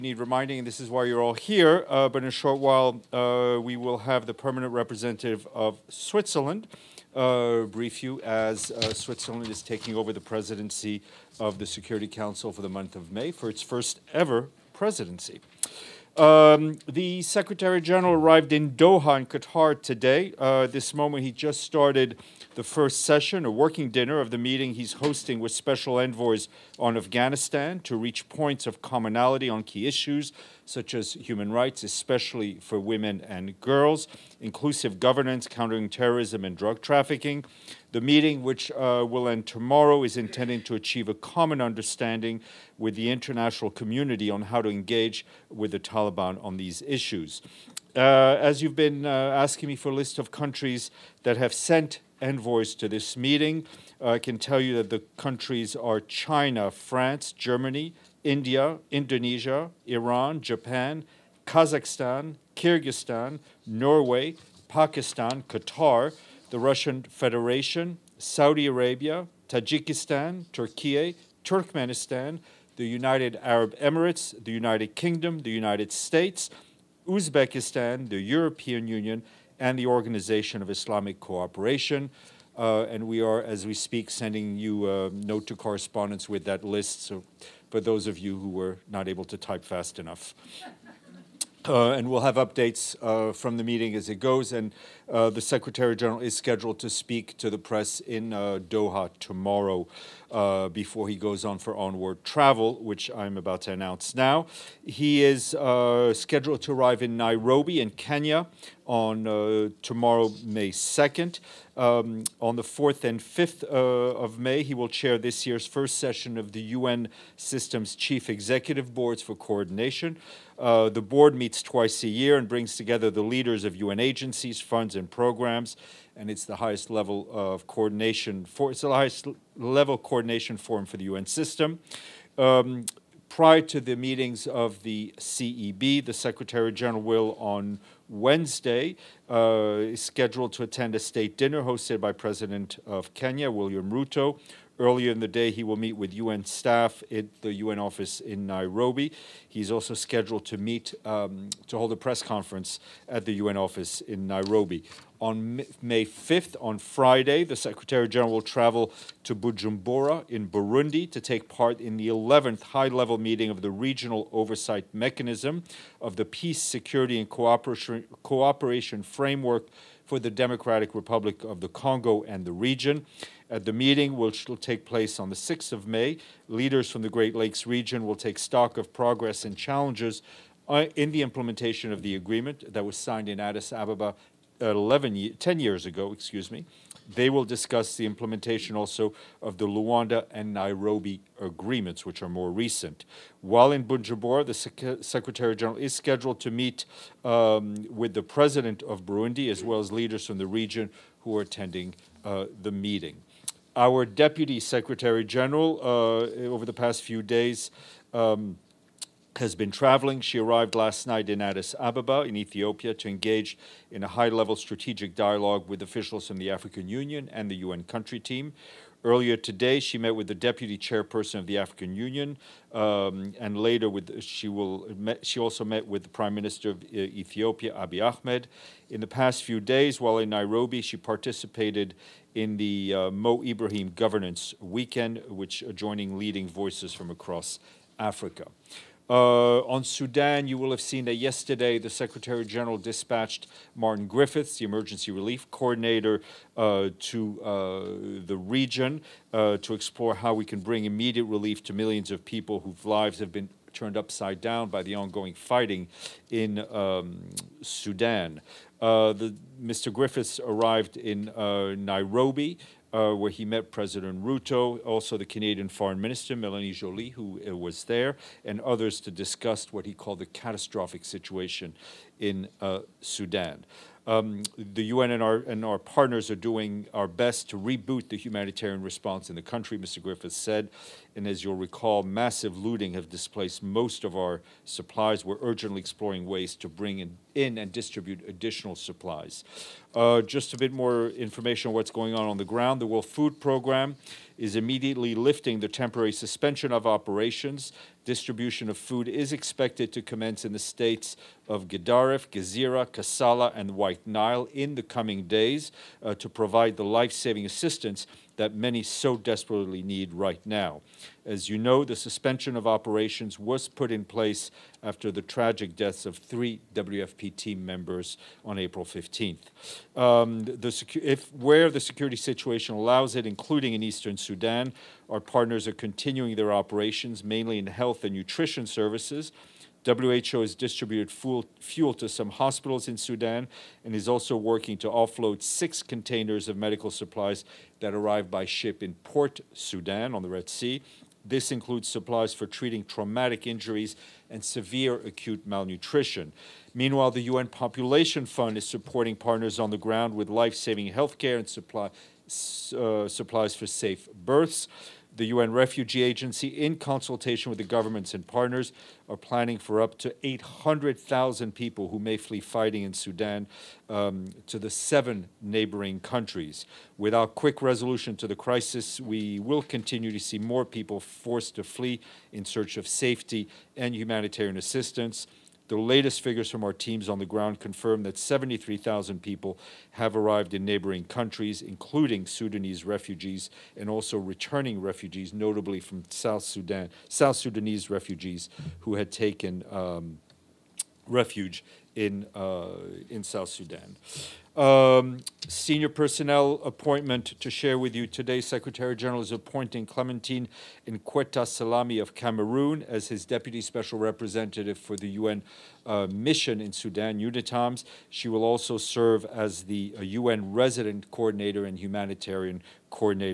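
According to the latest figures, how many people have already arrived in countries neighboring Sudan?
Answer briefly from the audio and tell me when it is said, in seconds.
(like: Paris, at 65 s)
73,000, at 378 s.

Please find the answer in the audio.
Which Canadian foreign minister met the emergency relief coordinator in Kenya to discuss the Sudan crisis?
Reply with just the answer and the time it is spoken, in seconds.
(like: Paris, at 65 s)
Melanie Joly, at 266 s.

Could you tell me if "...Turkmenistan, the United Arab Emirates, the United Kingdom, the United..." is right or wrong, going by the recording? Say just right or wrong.
right.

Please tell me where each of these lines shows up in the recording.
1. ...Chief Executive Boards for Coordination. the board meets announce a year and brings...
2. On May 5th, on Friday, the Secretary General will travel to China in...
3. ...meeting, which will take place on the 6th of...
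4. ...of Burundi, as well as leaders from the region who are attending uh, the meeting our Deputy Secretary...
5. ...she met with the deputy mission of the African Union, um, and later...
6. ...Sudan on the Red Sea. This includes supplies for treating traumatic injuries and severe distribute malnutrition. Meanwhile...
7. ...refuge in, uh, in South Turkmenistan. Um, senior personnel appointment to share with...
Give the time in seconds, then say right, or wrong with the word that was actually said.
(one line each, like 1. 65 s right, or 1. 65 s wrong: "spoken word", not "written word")
1. 117 s wrong: "twice", not "announce"
2. 155 s wrong: "Bujumbura", not "China"
3. 173 s right
4. 198 s right
5. 219 s wrong: "chairperson", not "mission"
6. 339 s wrong: "acute", not "distribute"
7. 391 s wrong: "Sudan", not "Turkmenistan".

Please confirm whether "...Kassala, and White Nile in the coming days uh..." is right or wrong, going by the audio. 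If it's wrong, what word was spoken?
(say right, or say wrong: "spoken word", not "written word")
right.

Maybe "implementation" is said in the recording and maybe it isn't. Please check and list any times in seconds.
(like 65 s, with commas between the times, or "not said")
181 s, 188 s.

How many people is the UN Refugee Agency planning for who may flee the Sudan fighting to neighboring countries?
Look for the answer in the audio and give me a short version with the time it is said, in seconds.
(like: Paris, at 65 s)
800,000, at 360 s.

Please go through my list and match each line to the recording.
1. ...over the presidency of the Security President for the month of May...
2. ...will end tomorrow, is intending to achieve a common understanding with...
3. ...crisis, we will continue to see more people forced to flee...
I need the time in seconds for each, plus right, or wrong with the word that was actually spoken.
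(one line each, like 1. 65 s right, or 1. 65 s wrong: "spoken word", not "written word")
1. 9 s wrong: "Council", not "President"
2. 39 s right
3. 368 s right.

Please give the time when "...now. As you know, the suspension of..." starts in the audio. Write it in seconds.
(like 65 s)
310 s.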